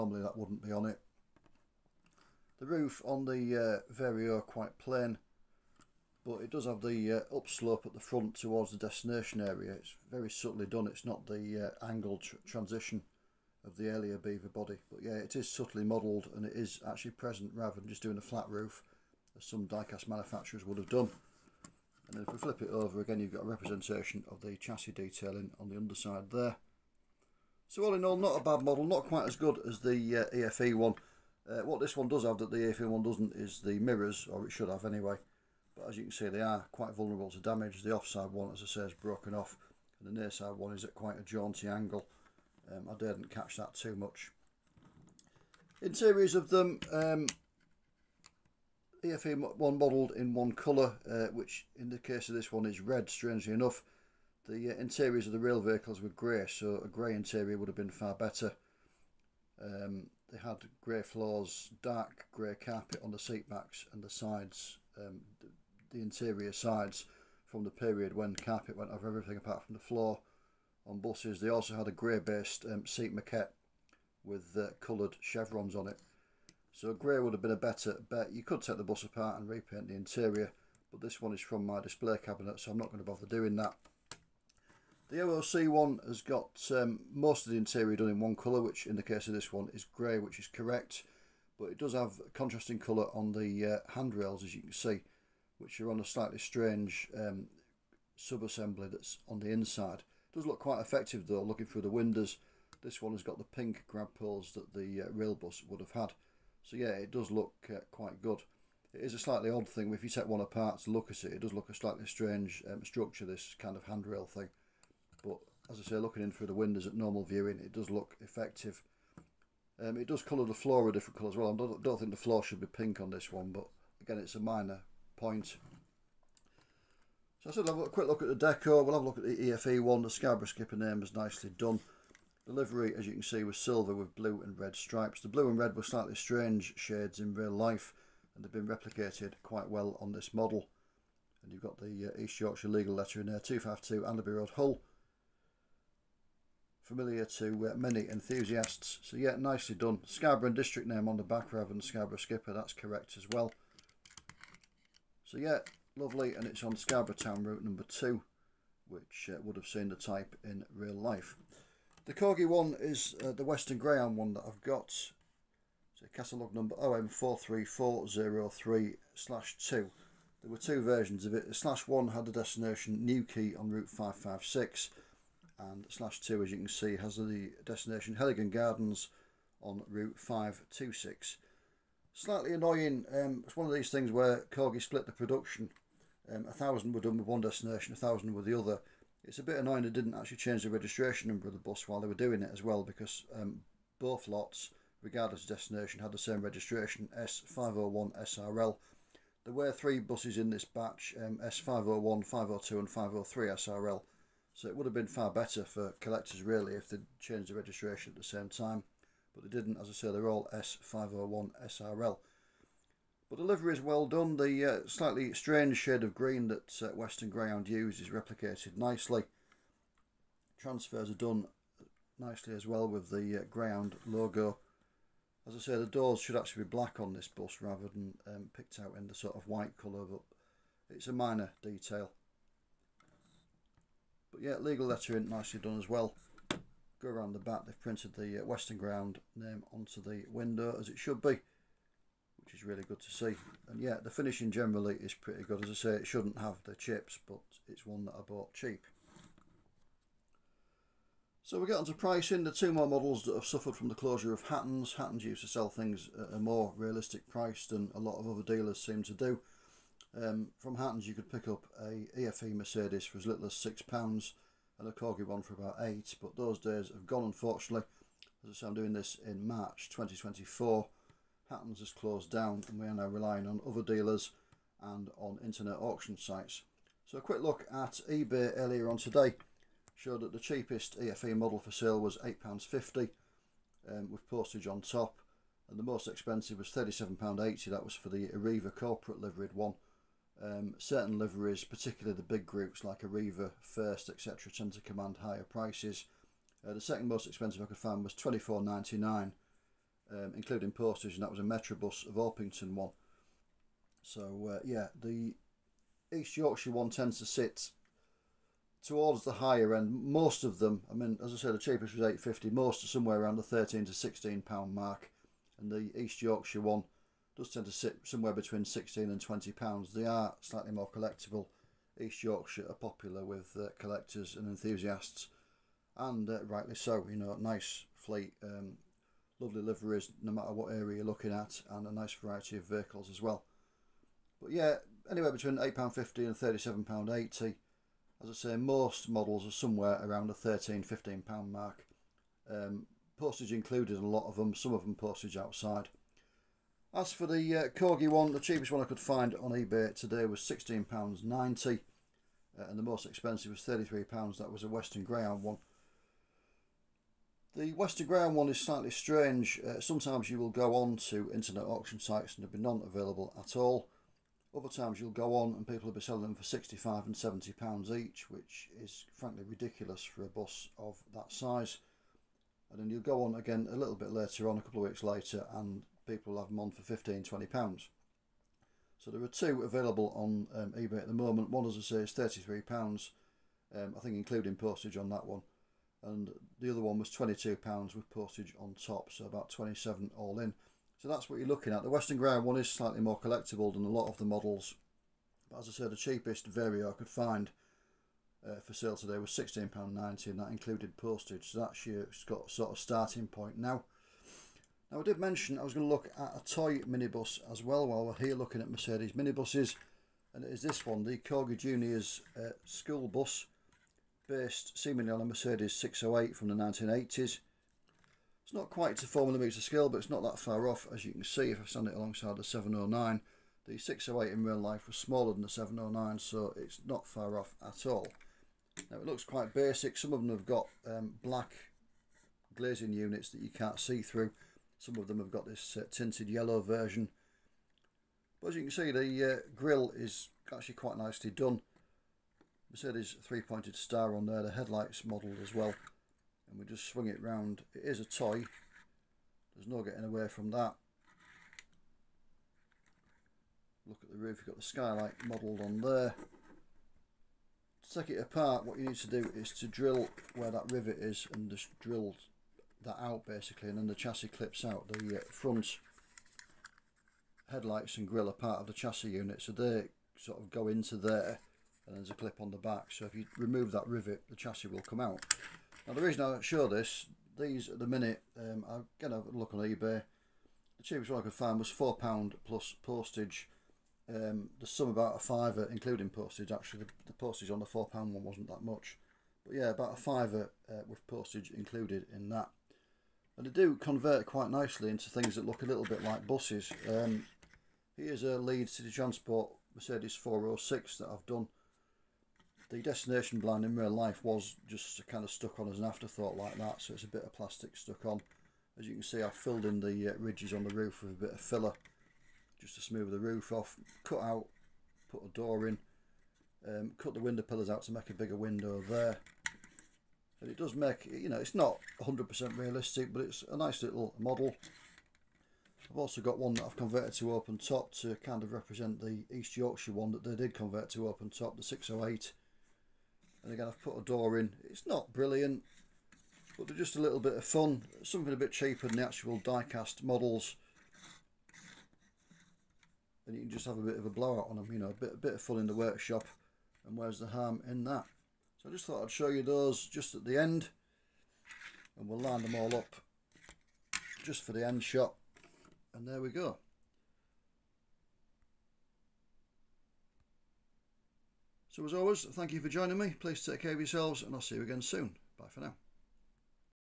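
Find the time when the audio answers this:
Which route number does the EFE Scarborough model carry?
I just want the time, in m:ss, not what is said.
2:37.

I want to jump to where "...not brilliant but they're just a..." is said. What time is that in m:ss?
8:54.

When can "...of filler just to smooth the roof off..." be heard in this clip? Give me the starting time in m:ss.
8:31.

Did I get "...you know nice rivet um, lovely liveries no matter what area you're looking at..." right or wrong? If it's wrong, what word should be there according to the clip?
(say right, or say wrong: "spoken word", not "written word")
wrong: "fleet", not "rivet".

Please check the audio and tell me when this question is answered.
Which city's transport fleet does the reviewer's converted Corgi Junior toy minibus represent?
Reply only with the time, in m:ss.
8:18.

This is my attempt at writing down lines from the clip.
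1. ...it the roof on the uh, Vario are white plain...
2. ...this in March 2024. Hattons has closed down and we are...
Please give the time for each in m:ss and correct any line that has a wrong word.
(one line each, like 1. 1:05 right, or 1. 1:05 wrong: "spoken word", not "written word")
1. 0:00 wrong: "quite", not "white"
2. 4:28 right.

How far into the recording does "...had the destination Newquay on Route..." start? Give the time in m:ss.
2:52.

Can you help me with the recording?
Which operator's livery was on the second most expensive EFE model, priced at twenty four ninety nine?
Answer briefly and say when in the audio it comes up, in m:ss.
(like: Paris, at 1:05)
Metrobus of Orpington, at 5:01.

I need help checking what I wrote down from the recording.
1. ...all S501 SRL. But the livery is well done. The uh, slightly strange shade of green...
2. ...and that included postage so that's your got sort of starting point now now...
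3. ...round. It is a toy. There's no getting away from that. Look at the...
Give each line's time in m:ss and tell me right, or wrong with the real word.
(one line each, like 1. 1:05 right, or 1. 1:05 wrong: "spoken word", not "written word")
1. 3:30 right
2. 6:40 right
3. 7:27 right.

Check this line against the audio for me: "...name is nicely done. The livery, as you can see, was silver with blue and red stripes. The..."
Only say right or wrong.
right.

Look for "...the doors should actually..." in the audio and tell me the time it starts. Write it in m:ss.
3:45.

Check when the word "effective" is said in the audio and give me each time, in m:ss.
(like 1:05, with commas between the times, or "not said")
1:40, 1:58.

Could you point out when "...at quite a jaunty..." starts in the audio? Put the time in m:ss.
0:40.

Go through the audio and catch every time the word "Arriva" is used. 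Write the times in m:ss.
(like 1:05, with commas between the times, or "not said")
4:48, 4:53.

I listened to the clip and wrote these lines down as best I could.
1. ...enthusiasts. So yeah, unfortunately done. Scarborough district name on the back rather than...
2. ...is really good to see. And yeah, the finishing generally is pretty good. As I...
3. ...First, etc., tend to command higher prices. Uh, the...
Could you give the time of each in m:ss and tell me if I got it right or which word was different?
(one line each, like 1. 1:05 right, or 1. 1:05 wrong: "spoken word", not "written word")
1. 2:28 wrong: "nicely", not "unfortunately"
2. 4:02 right
3. 4:53 right.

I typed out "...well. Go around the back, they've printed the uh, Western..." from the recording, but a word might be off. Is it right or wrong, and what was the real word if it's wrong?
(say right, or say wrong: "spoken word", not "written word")
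right.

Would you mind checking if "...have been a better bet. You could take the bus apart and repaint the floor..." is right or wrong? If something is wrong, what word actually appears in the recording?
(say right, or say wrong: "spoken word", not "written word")
wrong: "interior", not "floor".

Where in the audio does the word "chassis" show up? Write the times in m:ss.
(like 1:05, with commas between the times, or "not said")
0:24, 7:43, 7:48, 7:54.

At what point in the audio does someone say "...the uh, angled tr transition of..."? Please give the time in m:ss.
0:11.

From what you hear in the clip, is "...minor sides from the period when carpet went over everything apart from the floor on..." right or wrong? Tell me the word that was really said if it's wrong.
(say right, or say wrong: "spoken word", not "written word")
wrong: "interior", not "minor".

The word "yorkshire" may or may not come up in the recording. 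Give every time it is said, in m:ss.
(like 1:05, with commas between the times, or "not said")
2:22, 5:06, 5:16, 5:22, 8:49.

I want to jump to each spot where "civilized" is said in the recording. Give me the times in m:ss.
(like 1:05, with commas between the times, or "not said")
not said.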